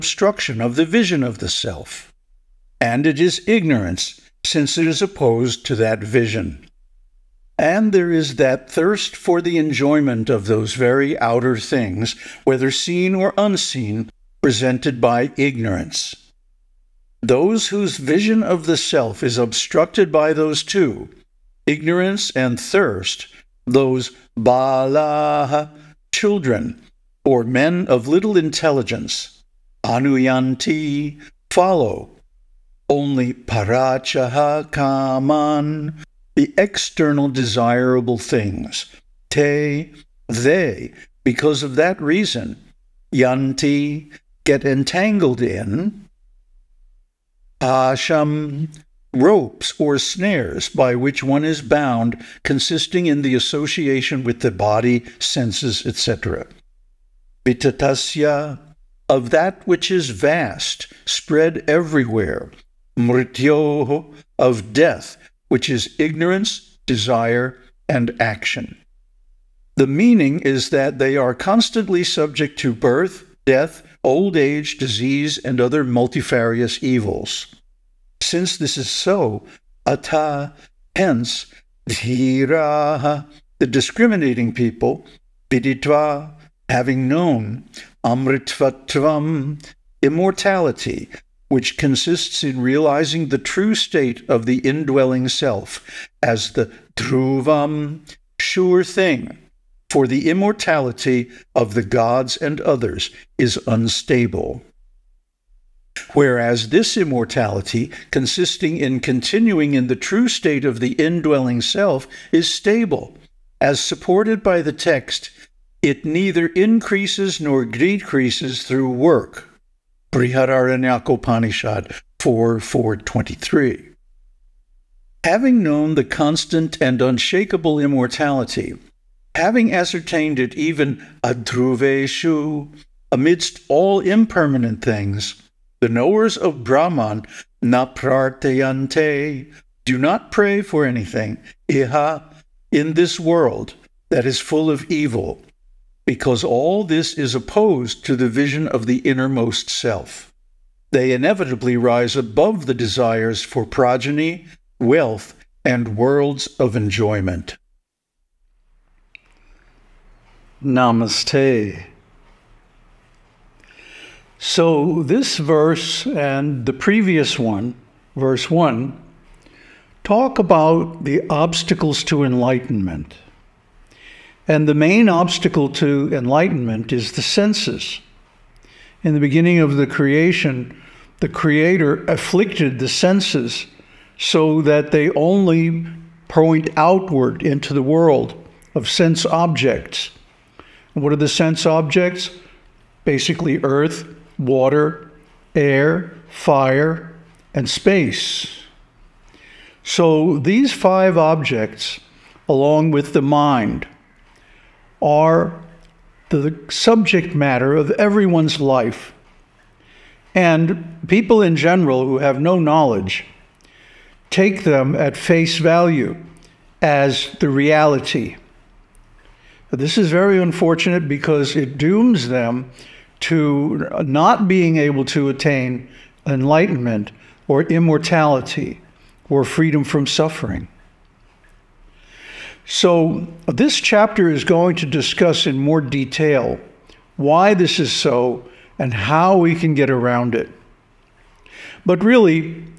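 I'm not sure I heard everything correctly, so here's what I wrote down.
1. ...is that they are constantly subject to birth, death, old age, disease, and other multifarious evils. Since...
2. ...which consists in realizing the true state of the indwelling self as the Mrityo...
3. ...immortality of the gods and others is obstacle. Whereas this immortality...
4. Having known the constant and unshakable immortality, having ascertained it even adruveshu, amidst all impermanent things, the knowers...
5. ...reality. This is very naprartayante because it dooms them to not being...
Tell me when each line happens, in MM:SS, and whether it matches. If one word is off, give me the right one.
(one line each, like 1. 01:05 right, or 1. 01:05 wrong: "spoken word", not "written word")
1. 01:10 right
2. 01:31 wrong: "Dhruvam", not "Mrityo"
3. 01:40 wrong: "unstable", not "obstacle"
4. 02:05 right
5. 03:37 wrong: "unfortunate", not "naprartayante".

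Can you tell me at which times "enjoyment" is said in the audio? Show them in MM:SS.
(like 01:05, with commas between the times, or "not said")
00:09, 02:36.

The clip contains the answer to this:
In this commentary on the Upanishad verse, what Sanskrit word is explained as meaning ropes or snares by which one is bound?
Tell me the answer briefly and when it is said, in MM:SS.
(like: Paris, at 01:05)
asham, at 00:47.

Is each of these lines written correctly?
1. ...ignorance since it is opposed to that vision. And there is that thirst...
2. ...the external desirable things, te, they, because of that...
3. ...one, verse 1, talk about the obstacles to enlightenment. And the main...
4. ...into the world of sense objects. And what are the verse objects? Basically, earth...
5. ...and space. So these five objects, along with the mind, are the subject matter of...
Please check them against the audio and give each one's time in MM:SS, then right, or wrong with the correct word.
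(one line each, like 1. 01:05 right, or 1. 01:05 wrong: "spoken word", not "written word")
1. 00:03 right
2. 00:36 right
3. 02:47 right
4. 03:07 wrong: "sense", not "verse"
5. 03:17 right.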